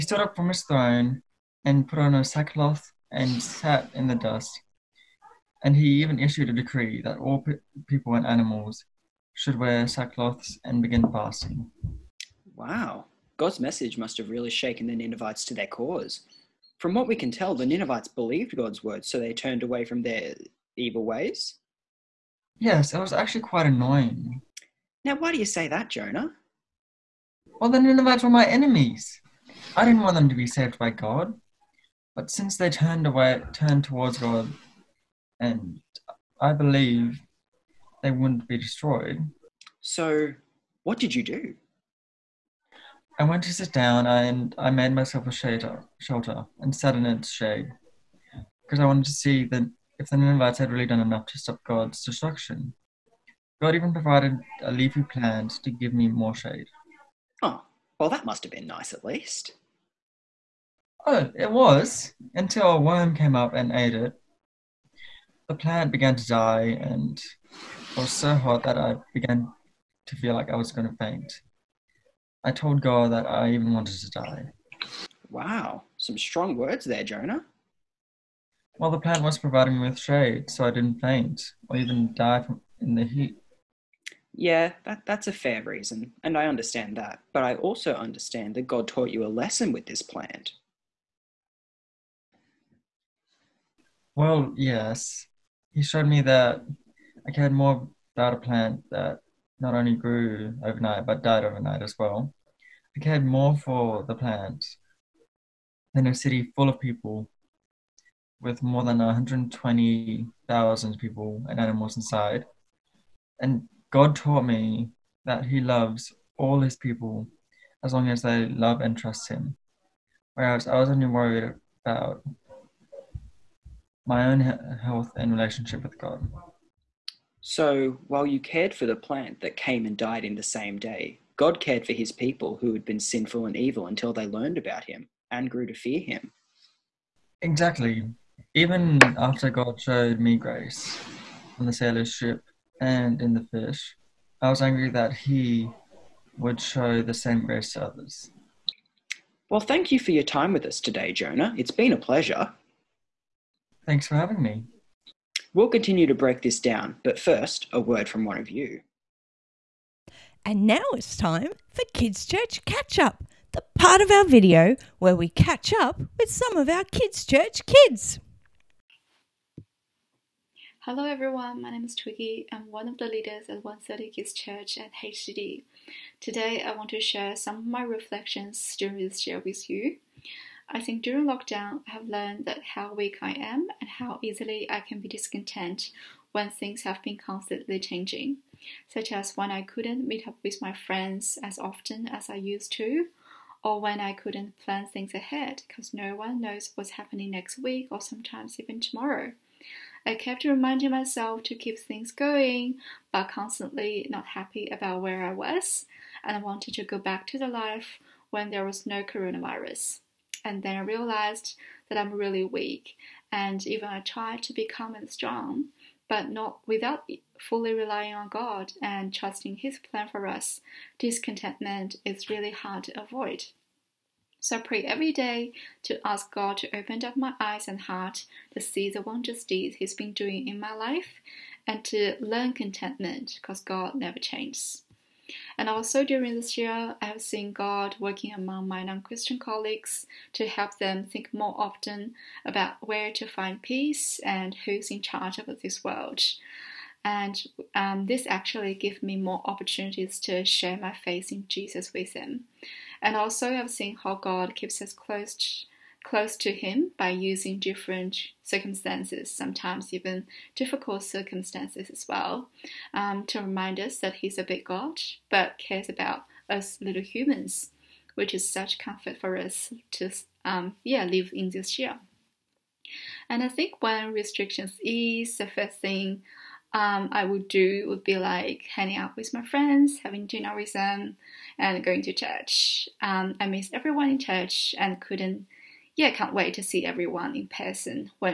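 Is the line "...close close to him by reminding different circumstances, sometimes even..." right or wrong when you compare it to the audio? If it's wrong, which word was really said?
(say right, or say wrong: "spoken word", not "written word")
wrong: "using", not "reminding".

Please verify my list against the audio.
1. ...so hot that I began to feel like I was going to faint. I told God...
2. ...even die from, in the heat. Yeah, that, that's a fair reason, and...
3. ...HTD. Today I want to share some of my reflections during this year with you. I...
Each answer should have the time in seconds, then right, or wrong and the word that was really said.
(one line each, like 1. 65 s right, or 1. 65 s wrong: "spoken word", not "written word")
1. 68 s right
2. 81 s right
3. 175 s right.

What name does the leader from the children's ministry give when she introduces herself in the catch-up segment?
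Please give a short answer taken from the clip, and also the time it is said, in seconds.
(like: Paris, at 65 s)
Twiggy, at 171 s.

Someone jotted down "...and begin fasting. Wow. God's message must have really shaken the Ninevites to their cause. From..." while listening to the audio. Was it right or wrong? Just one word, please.
right.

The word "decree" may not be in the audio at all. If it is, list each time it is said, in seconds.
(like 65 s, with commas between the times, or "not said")
6 s.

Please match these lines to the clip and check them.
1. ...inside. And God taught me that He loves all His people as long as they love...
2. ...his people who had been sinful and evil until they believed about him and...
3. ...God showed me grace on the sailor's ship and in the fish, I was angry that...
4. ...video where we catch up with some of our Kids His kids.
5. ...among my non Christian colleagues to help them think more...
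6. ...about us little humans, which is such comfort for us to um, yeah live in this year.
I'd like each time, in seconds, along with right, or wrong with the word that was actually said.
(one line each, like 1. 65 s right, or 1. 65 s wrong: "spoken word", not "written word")
1. 111 s right
2. 131 s wrong: "learned", not "believed"
3. 139 s right
4. 164 s wrong: "Church", not "His"
5. 238 s right
6. 265 s right.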